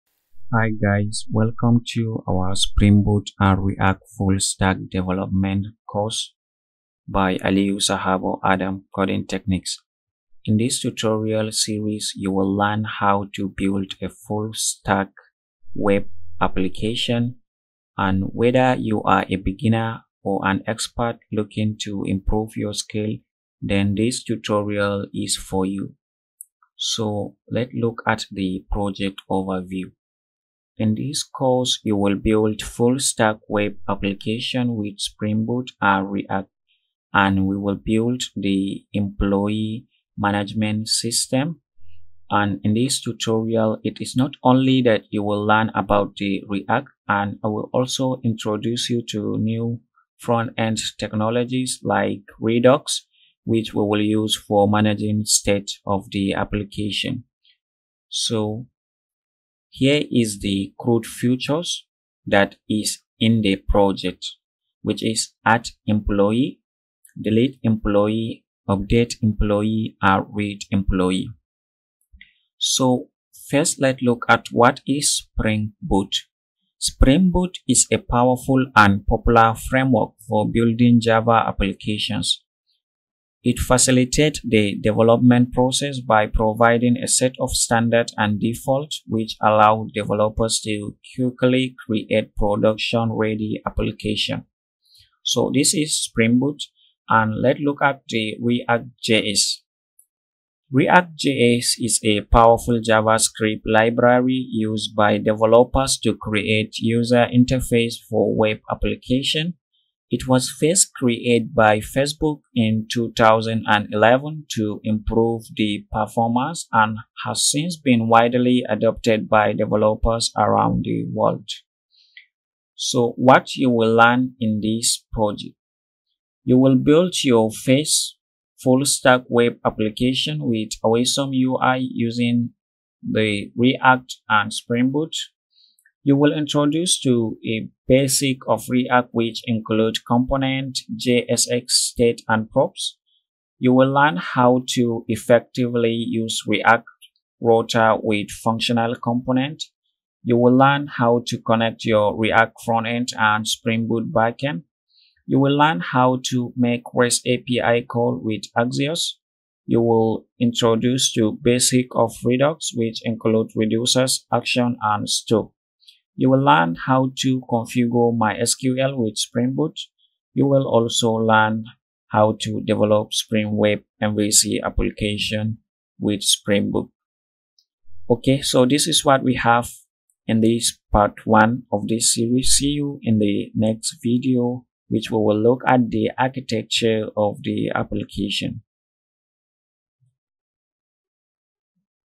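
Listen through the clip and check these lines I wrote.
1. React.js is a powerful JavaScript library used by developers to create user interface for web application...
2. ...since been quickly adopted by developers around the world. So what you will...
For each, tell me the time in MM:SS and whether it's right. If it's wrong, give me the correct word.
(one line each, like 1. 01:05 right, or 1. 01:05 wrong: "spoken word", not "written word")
1. 01:40 right
2. 01:57 wrong: "widely", not "quickly".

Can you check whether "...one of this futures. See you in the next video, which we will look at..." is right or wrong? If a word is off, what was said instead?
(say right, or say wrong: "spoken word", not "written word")
wrong: "series", not "futures".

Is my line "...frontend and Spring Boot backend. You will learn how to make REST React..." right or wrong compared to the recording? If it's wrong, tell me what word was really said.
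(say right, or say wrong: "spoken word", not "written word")
wrong: "API", not "React".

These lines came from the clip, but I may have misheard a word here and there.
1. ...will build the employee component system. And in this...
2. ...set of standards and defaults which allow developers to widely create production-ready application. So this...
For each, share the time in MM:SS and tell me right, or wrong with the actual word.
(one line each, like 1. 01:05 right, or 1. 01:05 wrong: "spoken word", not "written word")
1. 00:37 wrong: "management", not "component"
2. 01:27 wrong: "quickly", not "widely".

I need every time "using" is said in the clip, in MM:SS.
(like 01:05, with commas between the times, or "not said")
02:11.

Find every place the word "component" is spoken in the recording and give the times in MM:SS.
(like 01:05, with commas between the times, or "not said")
02:20, 02:28.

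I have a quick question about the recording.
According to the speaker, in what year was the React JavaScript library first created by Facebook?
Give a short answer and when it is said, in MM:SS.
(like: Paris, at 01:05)
2011, at 01:52.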